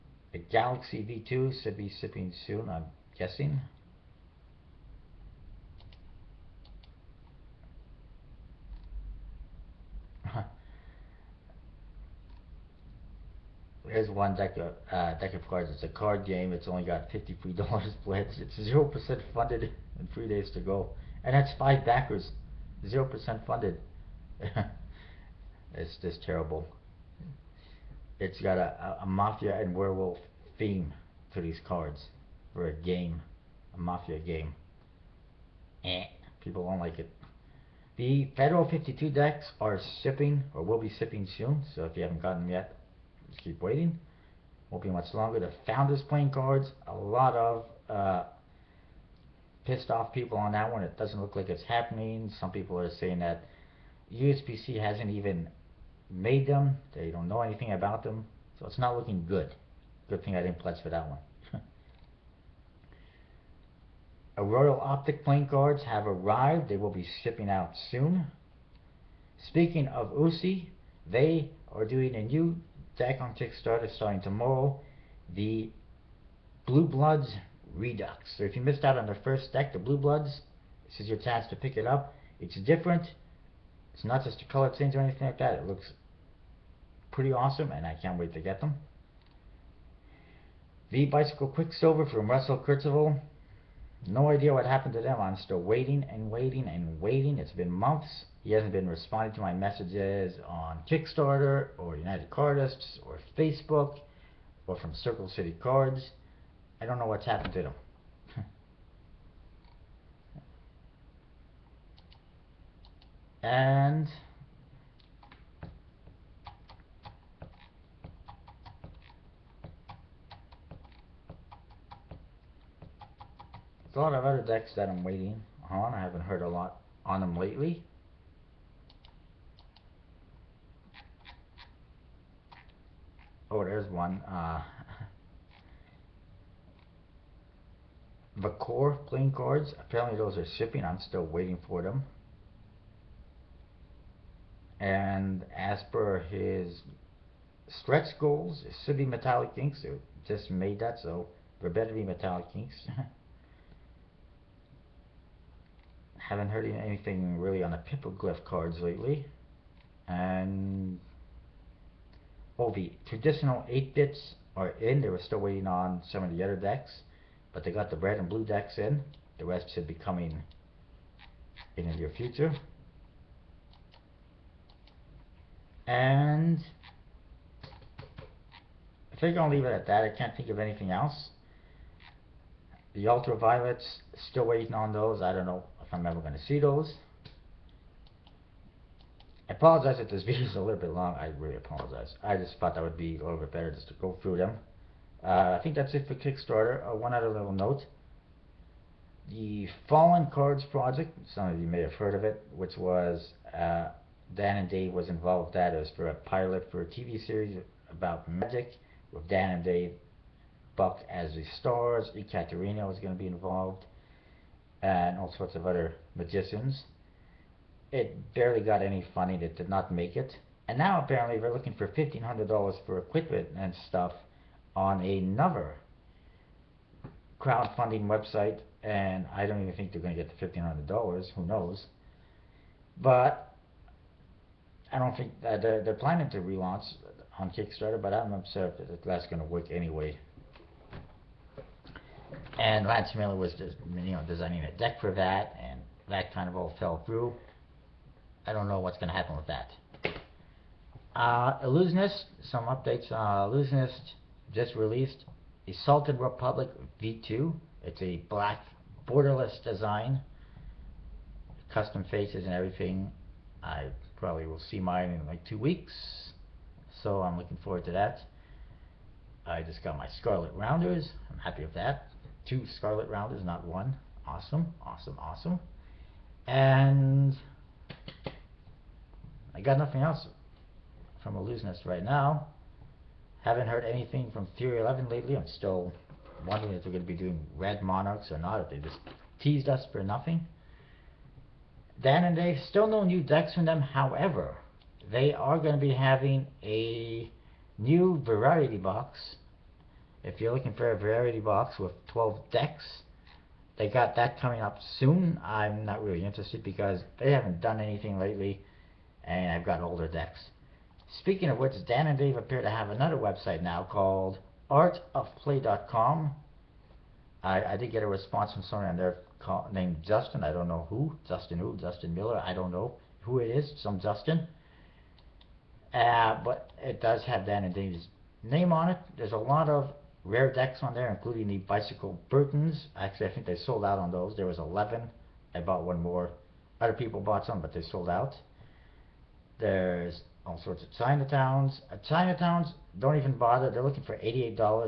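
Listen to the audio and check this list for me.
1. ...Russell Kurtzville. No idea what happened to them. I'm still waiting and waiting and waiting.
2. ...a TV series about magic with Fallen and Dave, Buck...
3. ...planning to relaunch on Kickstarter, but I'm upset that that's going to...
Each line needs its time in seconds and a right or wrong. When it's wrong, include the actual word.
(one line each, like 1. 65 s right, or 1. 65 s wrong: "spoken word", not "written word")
1. 92 s right
2. 206 s wrong: "Dan", not "Fallen"
3. 235 s right.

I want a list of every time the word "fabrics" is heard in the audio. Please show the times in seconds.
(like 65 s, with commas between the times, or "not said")
not said.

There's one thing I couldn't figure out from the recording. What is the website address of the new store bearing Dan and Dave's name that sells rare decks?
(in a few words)
artofplay.com.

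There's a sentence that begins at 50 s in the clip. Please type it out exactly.
It doesn't look like it's happening.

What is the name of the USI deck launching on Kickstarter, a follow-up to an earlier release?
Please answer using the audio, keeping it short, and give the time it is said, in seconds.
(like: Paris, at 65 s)
Blue Bloods Redux, at 75 s.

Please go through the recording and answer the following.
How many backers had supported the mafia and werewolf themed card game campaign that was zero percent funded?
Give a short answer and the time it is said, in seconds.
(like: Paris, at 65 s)
5, at 21 s.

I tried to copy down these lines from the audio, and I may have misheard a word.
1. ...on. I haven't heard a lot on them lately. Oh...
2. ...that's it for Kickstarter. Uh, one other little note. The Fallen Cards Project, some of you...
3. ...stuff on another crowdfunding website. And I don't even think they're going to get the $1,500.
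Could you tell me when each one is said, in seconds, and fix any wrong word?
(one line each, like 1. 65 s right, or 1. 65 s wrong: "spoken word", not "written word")
1. 125 s right
2. 195 s right
3. 223 s right.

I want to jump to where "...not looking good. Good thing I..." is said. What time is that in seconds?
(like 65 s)
58 s.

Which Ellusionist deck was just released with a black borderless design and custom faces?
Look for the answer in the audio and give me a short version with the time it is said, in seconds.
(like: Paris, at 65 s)
Salted Republic V2, at 255 s.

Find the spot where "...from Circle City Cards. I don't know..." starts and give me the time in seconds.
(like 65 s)
104 s.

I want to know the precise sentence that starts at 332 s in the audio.
Actually, I think they sold out on those.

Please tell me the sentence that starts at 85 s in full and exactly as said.
It looks pretty awesome, and I can't wait to get them.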